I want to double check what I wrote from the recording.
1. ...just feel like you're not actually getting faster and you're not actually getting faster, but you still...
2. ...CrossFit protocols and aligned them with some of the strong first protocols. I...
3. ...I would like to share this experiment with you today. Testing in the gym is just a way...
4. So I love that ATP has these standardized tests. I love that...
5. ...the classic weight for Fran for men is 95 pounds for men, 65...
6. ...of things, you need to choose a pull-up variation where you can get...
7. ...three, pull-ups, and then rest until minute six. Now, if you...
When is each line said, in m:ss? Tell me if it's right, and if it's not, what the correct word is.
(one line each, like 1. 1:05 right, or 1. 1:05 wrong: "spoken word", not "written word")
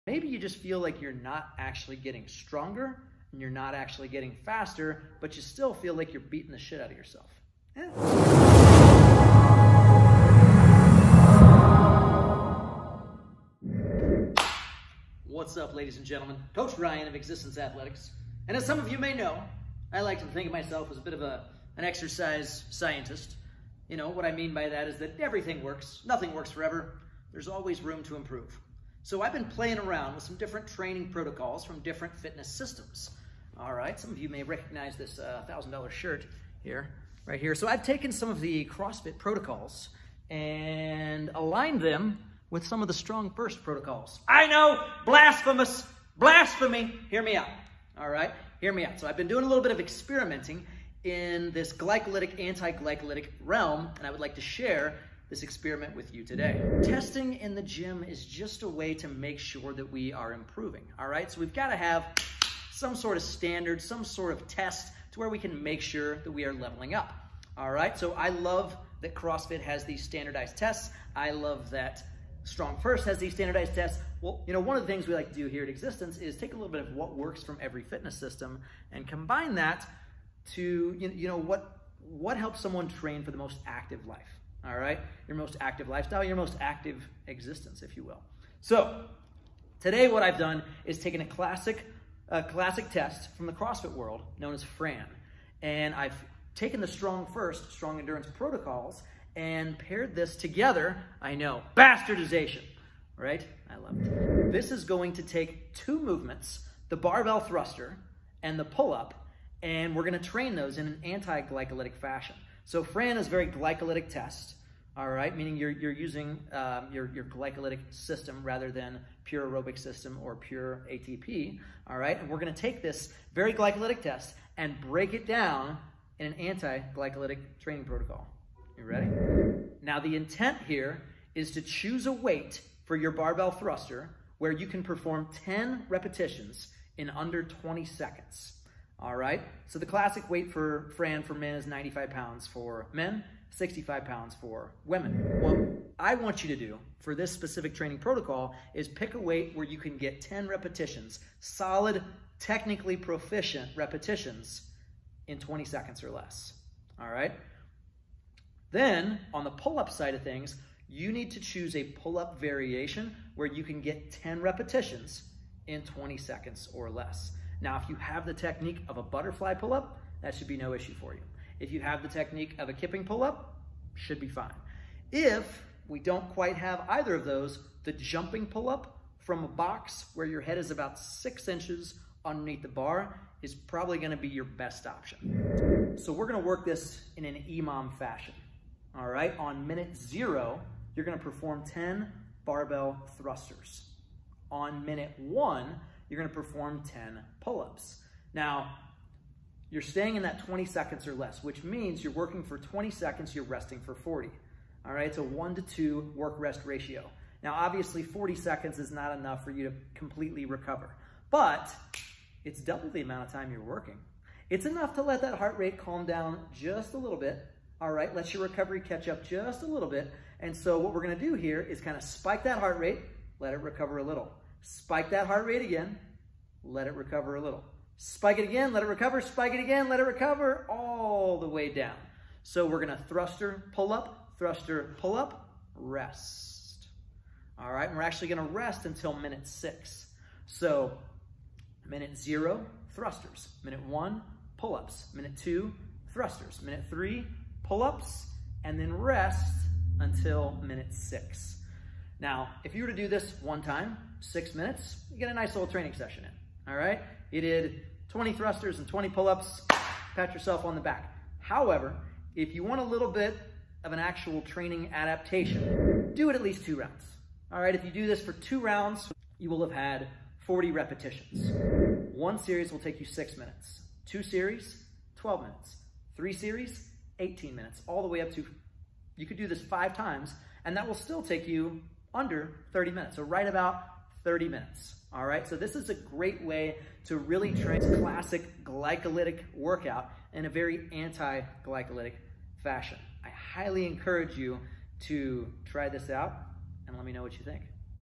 1. 0:00 wrong: "stronger", not "faster"
2. 0:38 right
3. 0:54 right
4. 1:07 wrong: "CrossFit", not "ATP"
5. 2:19 right
6. 2:40 right
7. 4:06 right.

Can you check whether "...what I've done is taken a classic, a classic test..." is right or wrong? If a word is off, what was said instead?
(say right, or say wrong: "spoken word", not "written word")
right.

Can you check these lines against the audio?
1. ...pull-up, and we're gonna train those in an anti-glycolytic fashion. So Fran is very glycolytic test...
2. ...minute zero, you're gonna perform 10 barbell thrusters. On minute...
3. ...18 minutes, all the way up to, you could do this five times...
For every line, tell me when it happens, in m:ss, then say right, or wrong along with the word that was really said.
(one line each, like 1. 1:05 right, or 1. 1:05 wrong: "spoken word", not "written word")
1. 1:48 right
2. 3:09 right
3. 4:37 right.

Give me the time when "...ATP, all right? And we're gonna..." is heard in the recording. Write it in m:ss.
2:00.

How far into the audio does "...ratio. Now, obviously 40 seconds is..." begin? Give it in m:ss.
3:26.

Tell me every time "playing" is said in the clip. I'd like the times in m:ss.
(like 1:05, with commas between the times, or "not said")
0:29.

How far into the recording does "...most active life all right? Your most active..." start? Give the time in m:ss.
1:23.